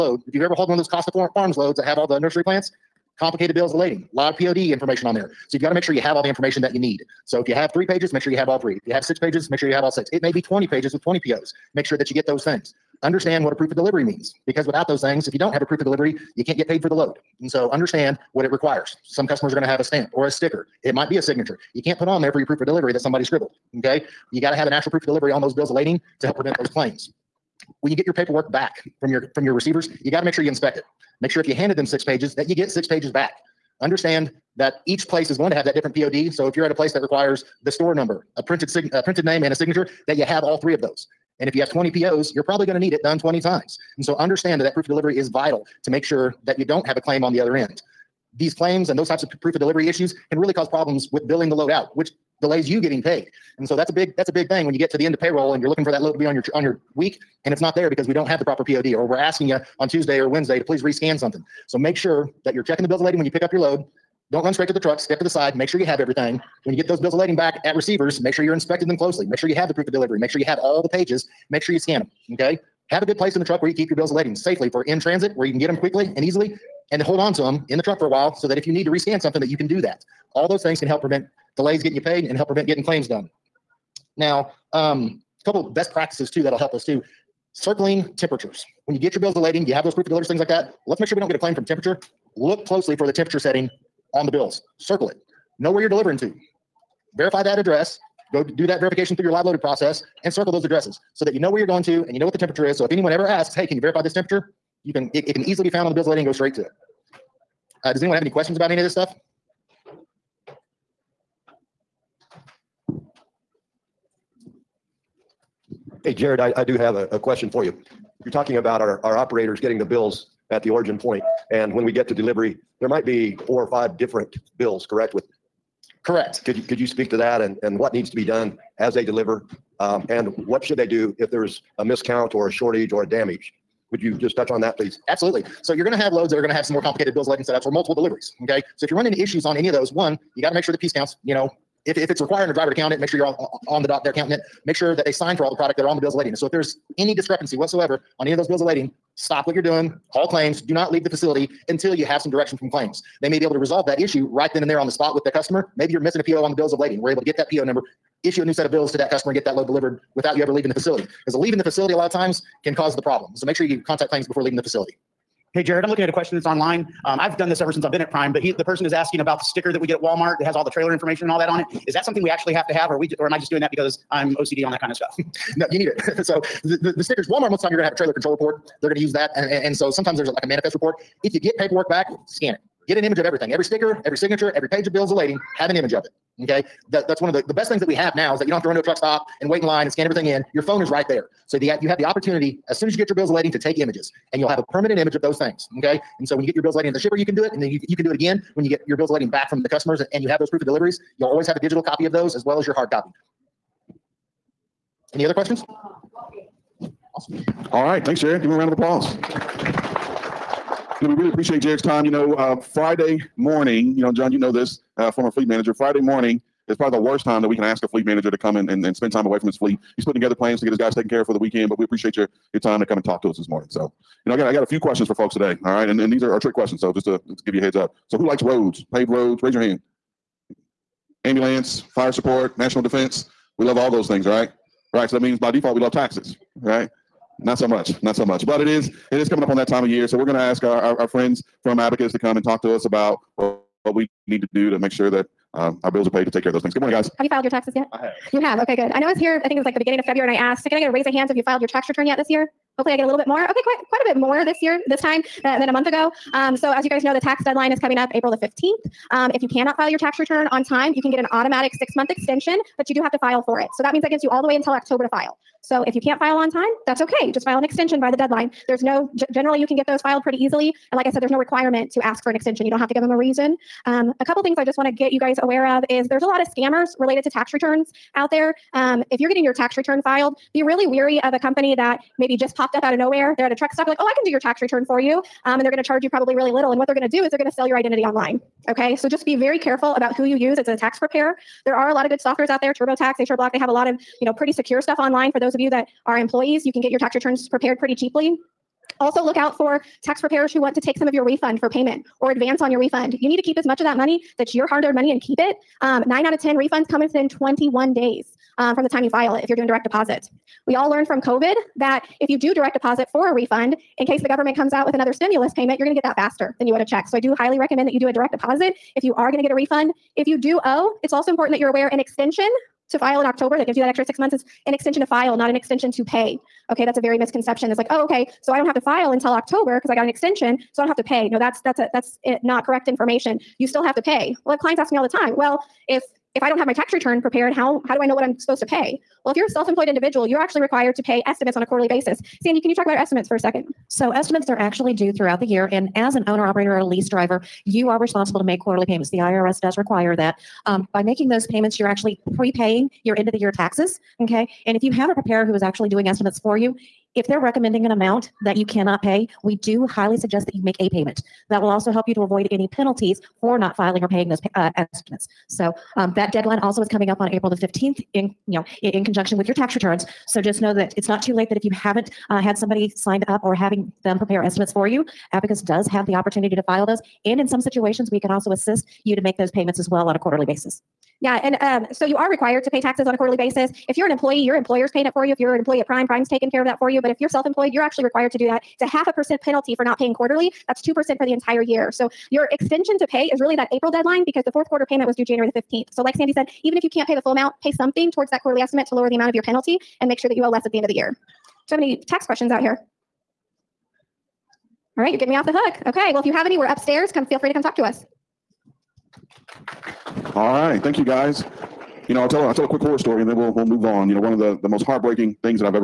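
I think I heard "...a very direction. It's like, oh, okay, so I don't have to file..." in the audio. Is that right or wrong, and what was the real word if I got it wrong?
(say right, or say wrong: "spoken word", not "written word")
wrong: "misconception", not "direction".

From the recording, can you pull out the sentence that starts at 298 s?
Also look out for tax preparers who want to take some of your refund for payment or advance on your refund.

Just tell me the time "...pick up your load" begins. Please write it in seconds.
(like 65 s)
63 s.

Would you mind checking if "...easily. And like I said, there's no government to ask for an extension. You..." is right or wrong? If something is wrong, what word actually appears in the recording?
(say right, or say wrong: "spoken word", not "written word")
wrong: "requirement", not "government".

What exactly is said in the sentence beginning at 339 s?
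Well, if you're a self-employed individual, you're actually required to pay estimates on a quarterly basis.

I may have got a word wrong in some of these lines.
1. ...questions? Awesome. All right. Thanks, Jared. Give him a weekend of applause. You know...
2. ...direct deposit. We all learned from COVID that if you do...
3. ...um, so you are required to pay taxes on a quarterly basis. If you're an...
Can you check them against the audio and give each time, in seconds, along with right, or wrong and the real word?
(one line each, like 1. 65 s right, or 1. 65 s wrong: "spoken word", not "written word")
1. 205 s wrong: "round", not "weekend"
2. 309 s right
3. 381 s right.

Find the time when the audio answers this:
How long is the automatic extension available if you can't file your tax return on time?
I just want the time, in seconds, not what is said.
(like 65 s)
261 s.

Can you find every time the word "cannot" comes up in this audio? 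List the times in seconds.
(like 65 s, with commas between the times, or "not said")
259 s, 358 s.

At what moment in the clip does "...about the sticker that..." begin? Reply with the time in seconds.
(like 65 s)
169 s.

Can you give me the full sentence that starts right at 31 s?
Make sure if you handed them six pages that you get six pages back.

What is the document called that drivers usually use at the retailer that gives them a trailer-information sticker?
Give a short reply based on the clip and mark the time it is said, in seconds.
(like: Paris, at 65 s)
trailer control report, at 177 s.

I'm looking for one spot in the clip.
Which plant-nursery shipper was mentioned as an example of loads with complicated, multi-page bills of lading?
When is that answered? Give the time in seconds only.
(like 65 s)
0 s.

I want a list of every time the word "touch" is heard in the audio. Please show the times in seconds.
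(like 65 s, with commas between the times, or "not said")
134 s.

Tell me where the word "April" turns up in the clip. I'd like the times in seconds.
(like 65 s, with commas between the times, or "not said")
258 s, 367 s, 393 s.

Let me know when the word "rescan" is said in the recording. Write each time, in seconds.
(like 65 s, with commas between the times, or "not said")
60 s, 78 s.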